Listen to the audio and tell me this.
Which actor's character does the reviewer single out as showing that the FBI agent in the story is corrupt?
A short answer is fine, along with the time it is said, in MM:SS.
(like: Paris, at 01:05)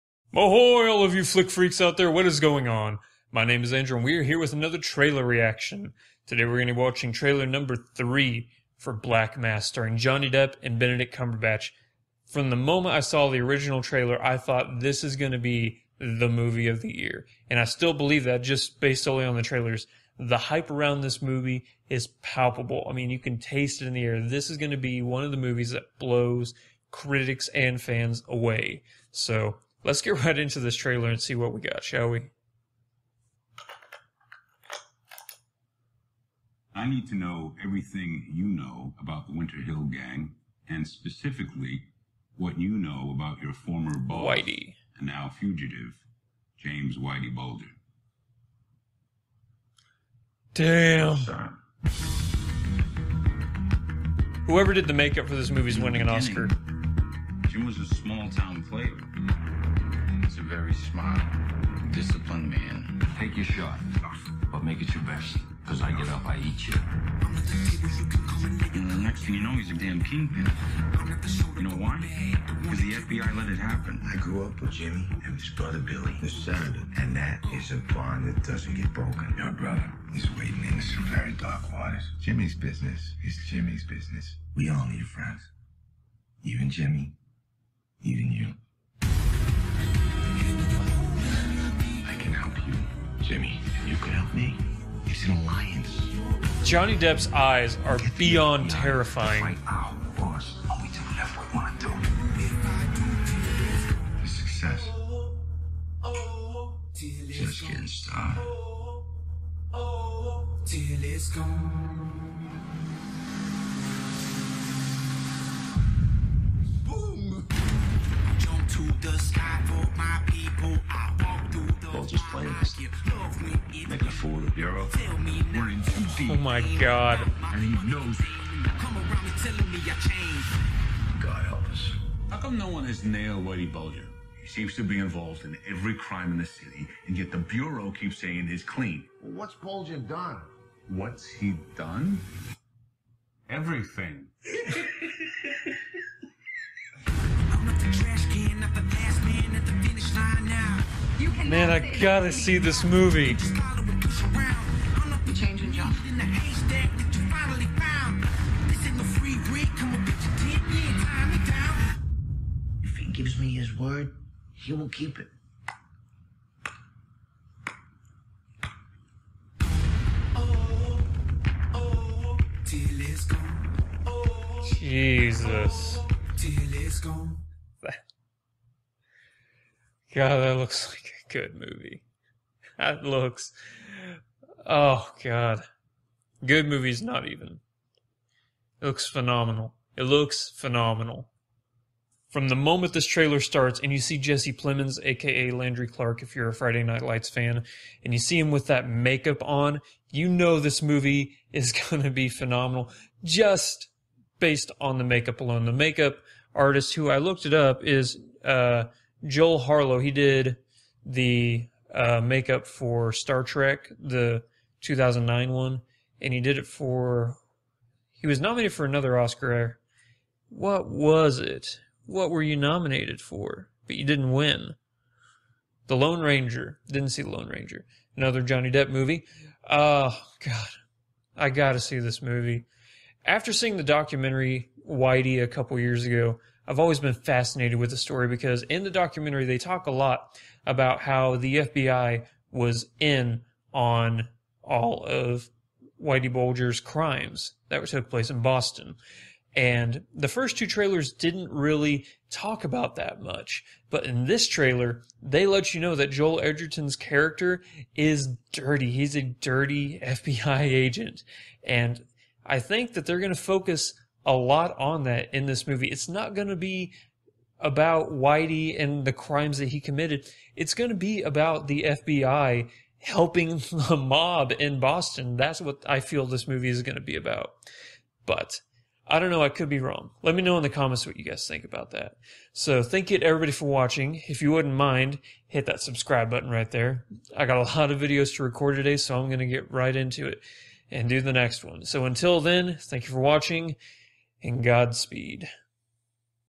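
Joel Edgerton, at 04:16.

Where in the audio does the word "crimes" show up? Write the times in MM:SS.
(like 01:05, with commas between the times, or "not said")
02:15, 04:06, 04:29.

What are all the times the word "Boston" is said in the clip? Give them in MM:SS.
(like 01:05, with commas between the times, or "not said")
04:08, 04:34.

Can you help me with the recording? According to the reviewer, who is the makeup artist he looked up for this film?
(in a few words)
Joel Harlow.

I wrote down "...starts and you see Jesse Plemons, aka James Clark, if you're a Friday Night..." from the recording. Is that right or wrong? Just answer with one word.
wrong.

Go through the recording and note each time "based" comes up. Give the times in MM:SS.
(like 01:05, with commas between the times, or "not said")
00:18, 03:24.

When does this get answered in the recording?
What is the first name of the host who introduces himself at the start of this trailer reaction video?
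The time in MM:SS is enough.
00:03.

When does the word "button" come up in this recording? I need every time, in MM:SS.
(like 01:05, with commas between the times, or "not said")
04:46.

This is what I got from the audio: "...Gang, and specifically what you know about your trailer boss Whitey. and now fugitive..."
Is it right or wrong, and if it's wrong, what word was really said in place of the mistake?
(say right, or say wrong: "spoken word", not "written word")
wrong: "former", not "trailer".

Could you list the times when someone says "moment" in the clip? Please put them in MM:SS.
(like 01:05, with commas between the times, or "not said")
00:12, 03:12.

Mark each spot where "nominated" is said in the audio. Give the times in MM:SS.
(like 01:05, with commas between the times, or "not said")
03:38, 03:42.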